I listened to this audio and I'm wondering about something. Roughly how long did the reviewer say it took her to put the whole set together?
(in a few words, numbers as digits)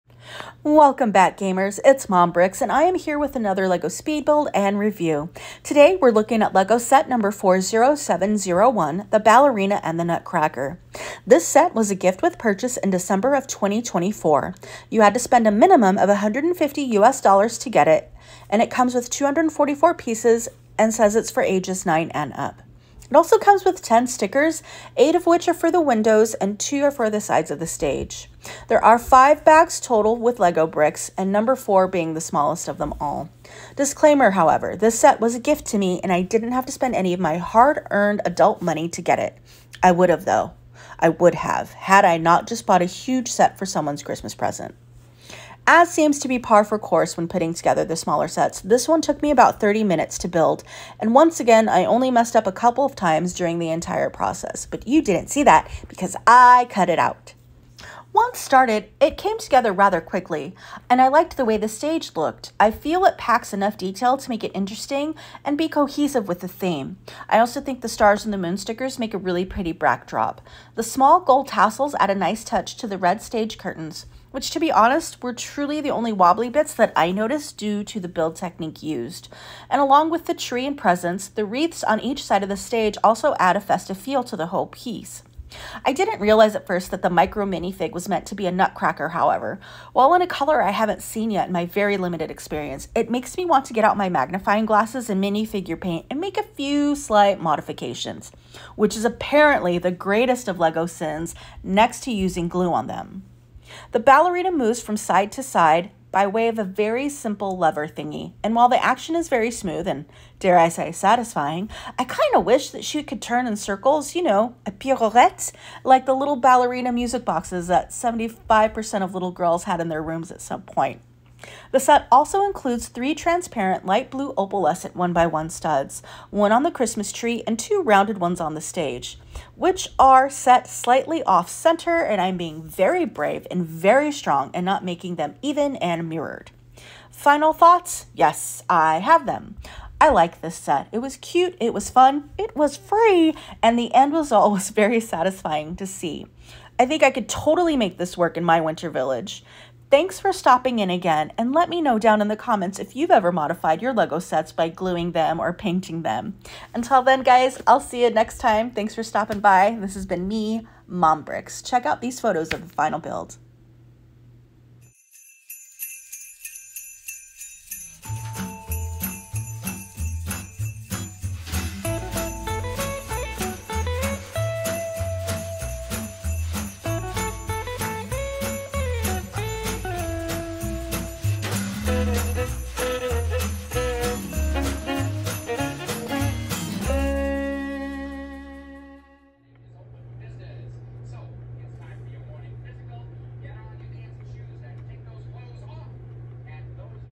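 30 minutes.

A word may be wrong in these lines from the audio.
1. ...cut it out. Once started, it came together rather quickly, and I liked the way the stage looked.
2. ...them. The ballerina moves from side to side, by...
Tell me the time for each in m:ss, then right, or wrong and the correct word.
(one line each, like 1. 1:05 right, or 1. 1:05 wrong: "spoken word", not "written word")
1. 0:56 right
2. 1:42 right.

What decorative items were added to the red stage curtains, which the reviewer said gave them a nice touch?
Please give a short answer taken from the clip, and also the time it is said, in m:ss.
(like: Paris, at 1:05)
small gold tassels, at 1:10.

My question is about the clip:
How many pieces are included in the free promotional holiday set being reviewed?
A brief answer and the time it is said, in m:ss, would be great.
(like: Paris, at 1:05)
244, at 0:19.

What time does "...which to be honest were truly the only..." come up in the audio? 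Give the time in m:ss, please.
1:14.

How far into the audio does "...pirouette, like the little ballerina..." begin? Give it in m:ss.
1:54.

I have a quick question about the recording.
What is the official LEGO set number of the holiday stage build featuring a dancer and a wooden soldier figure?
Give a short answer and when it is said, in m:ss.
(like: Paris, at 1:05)
40701, at 0:07.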